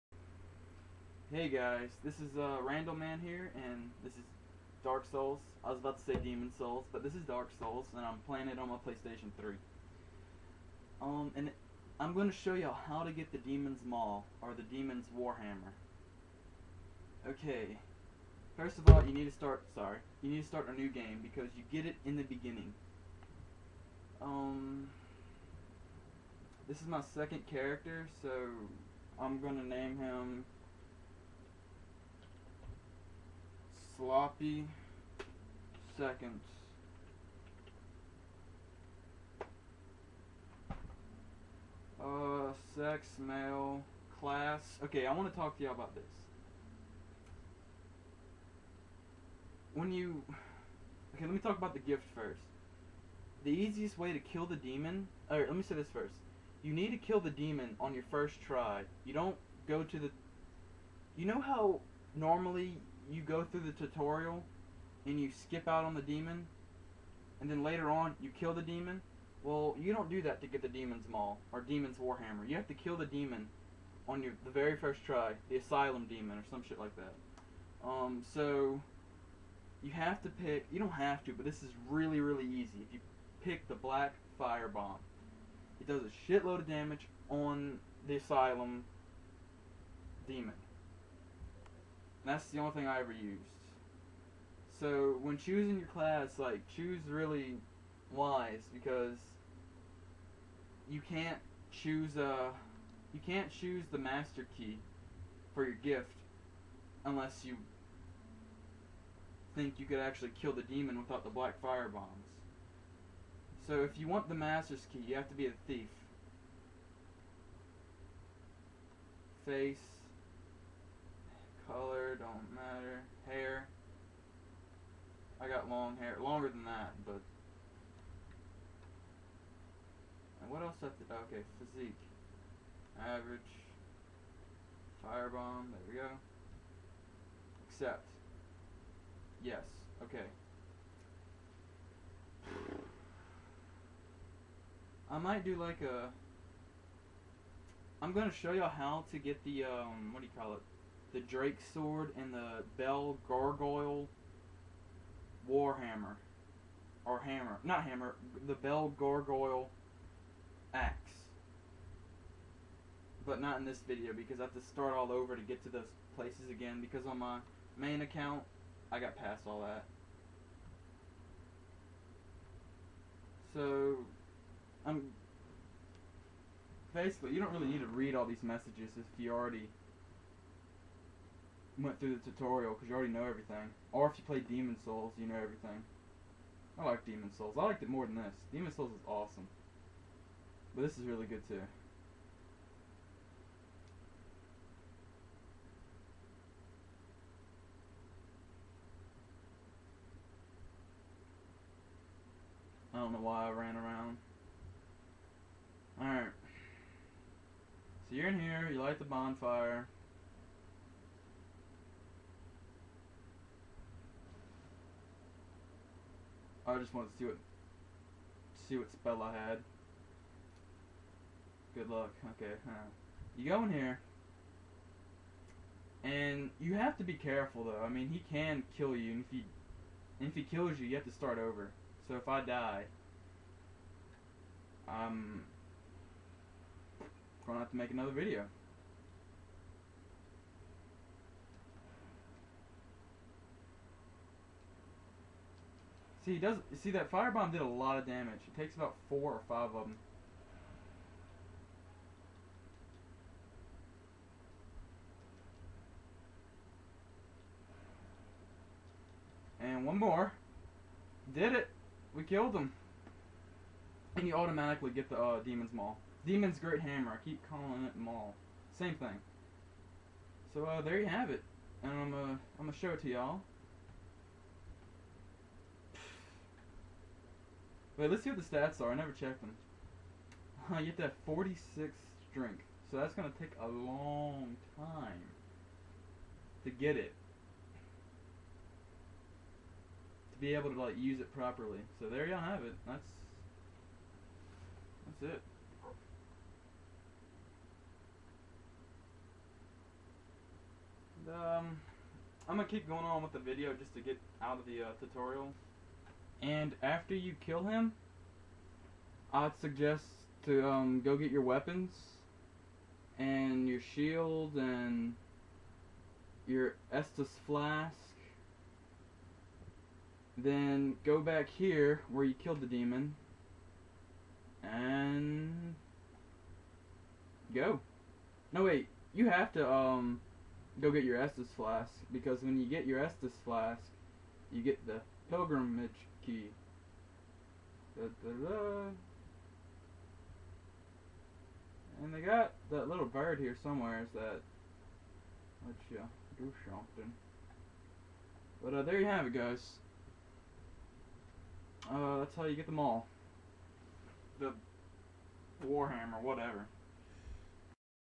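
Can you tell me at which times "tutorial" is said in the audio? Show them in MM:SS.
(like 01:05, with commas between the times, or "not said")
01:03, 03:02, 05:04.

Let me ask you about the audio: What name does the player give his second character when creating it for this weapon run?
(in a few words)
Sloppy seconds.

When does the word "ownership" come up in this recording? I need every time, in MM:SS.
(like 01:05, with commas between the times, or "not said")
not said.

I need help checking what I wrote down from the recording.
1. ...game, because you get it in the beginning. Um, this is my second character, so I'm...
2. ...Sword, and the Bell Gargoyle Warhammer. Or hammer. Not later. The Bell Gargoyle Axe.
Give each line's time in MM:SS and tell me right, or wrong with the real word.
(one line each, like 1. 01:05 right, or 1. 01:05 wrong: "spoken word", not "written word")
1. 00:20 right
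2. 02:31 wrong: "hammer", not "later".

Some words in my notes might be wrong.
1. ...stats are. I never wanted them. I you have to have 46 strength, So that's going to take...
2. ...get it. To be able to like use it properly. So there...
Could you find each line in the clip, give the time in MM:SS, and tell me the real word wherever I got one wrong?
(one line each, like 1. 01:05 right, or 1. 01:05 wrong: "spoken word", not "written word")
1. 04:38 wrong: "checked", not "wanted"
2. 04:46 right.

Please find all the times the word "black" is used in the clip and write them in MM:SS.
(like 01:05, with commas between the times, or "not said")
01:23, 01:51.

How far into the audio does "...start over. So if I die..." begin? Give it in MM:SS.
03:51.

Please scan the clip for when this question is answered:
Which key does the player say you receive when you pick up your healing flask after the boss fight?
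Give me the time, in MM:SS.
05:35.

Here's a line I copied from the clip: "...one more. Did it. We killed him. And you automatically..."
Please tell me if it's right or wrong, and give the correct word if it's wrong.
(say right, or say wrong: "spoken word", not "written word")
right.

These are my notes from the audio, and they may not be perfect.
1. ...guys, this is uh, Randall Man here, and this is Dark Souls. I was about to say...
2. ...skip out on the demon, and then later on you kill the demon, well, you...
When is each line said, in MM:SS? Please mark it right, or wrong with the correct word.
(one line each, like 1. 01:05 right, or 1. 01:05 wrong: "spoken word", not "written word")
1. 00:01 right
2. 01:05 right.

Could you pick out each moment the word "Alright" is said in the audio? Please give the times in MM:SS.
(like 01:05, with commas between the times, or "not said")
00:55, 03:26.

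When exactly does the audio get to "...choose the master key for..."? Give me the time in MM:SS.
01:43.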